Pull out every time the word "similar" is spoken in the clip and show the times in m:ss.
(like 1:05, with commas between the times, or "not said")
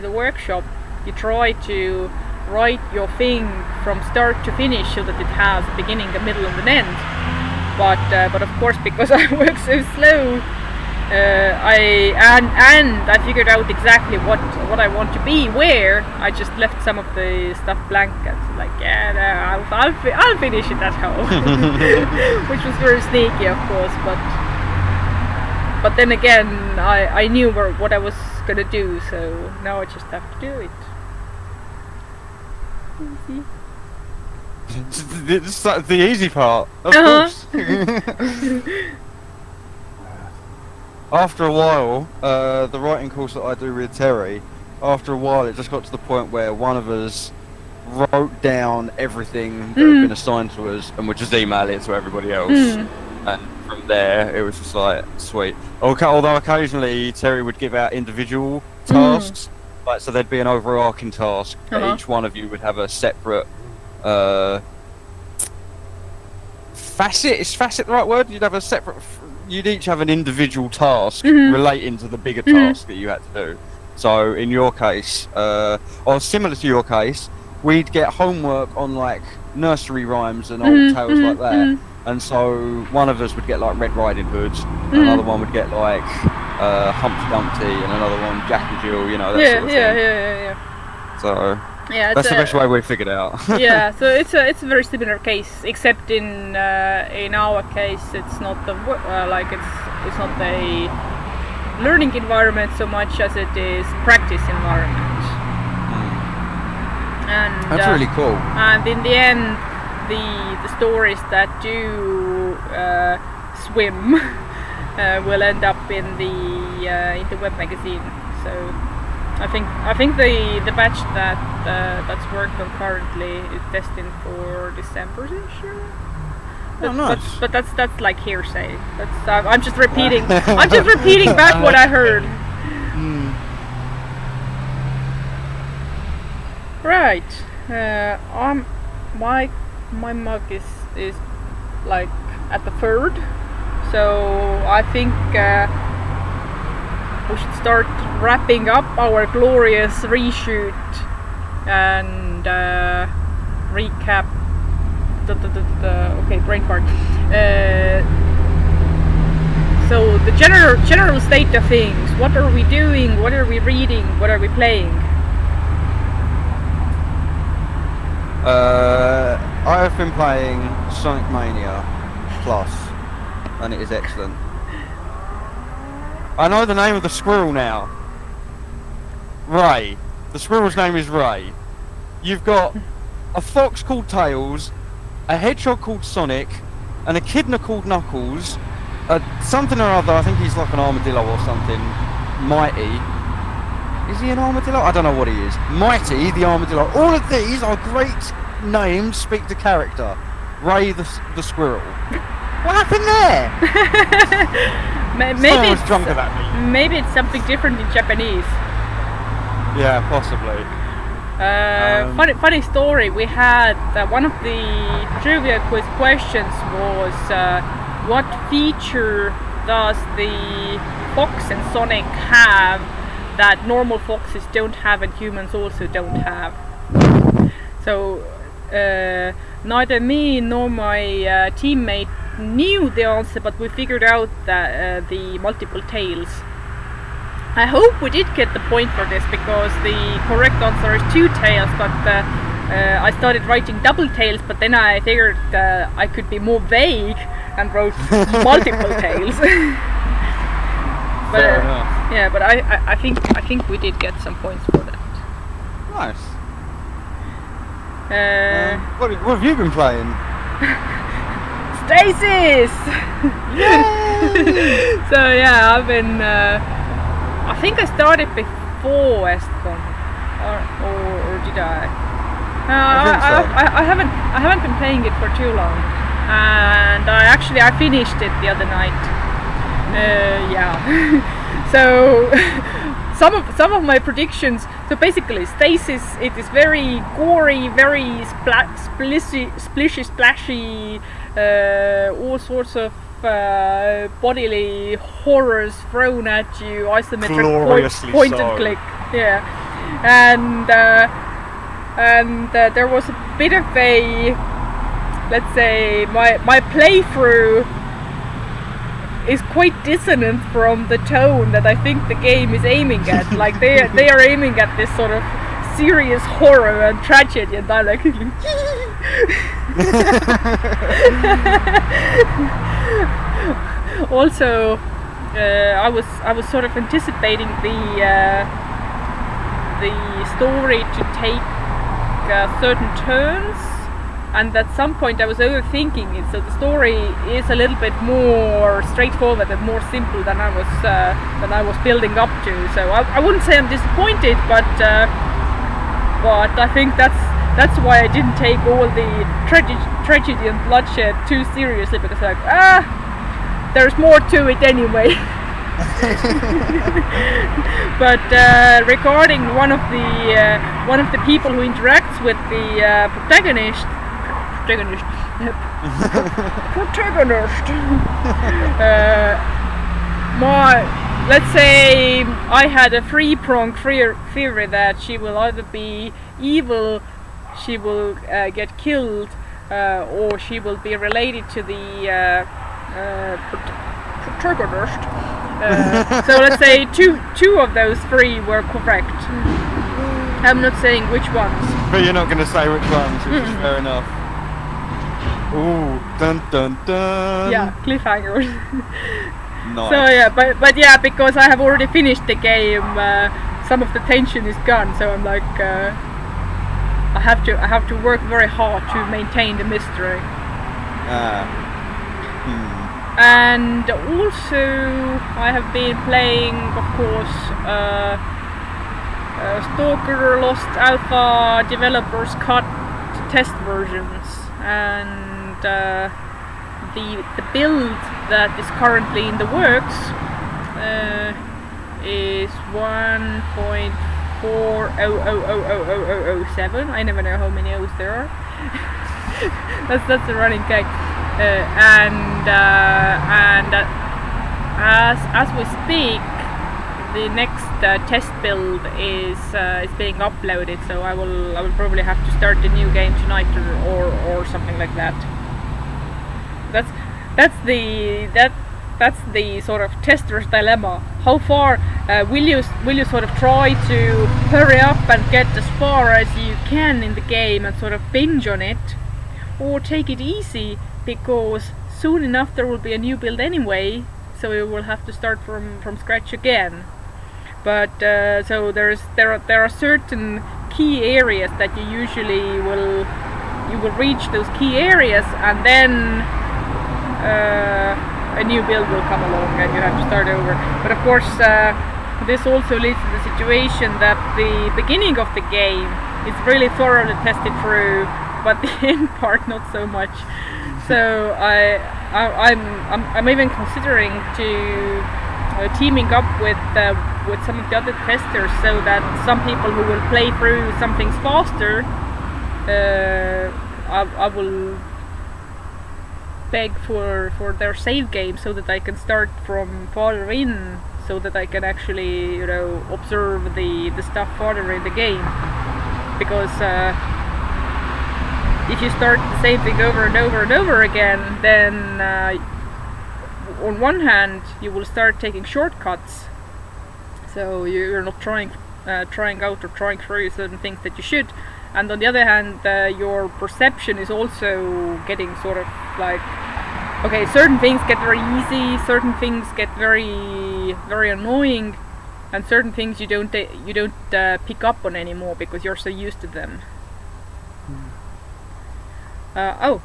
1:16, 1:34.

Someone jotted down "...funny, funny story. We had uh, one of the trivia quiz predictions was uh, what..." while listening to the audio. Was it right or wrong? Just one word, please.
wrong.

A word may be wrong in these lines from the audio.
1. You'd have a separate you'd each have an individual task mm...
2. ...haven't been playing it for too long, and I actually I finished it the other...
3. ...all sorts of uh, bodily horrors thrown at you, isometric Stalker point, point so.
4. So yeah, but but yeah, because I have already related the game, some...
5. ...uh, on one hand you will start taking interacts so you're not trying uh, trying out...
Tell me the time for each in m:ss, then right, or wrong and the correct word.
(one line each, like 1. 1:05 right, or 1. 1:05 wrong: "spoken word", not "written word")
1. 1:08 right
2. 4:34 right
3. 4:52 wrong: "Gloriously", not "Stalker"
4. 6:39 wrong: "finished", not "related"
5. 8:51 wrong: "shortcuts", not "interacts".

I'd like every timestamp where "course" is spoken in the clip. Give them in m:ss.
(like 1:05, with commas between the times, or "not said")
0:08, 0:23, 0:37, 0:43, 6:56, 8:11.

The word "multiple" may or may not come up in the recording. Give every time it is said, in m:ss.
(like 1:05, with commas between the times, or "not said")
3:55, 4:08.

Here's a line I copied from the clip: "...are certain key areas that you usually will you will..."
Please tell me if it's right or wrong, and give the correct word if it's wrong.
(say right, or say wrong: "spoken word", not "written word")
right.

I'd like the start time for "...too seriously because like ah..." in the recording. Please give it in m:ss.
5:51.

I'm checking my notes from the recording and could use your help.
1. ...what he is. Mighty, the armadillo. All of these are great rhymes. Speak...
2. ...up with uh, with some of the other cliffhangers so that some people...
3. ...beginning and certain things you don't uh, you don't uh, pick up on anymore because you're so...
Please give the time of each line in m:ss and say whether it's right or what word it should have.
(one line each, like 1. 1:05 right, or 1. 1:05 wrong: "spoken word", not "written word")
1. 3:15 wrong: "names", not "rhymes"
2. 8:26 wrong: "testers", not "cliffhangers"
3. 9:11 wrong: "annoying", not "beginning".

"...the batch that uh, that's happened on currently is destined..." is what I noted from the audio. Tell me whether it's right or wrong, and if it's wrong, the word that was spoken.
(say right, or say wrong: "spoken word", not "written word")
wrong: "worked", not "happened".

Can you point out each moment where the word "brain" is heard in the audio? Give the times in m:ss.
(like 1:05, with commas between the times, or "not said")
2:36.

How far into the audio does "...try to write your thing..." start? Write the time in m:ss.
0:01.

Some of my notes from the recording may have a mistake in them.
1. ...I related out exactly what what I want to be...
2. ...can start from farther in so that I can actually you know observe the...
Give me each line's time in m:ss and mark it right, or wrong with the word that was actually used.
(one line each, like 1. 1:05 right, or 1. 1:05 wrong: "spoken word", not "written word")
1. 0:13 wrong: "figured", not "related"
2. 8:38 right.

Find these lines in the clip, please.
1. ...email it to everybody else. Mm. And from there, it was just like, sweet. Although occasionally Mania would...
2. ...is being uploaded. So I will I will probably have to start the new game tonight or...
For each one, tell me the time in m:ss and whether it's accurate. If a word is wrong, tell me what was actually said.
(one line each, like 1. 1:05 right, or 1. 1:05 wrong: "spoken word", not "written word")
1. 0:51 wrong: "Terry", not "Mania"
2. 7:29 right.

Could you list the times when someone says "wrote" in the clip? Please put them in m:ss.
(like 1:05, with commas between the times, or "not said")
0:47, 4:07.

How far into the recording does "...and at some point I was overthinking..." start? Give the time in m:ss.
5:34.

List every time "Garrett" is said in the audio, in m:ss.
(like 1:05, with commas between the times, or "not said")
not said.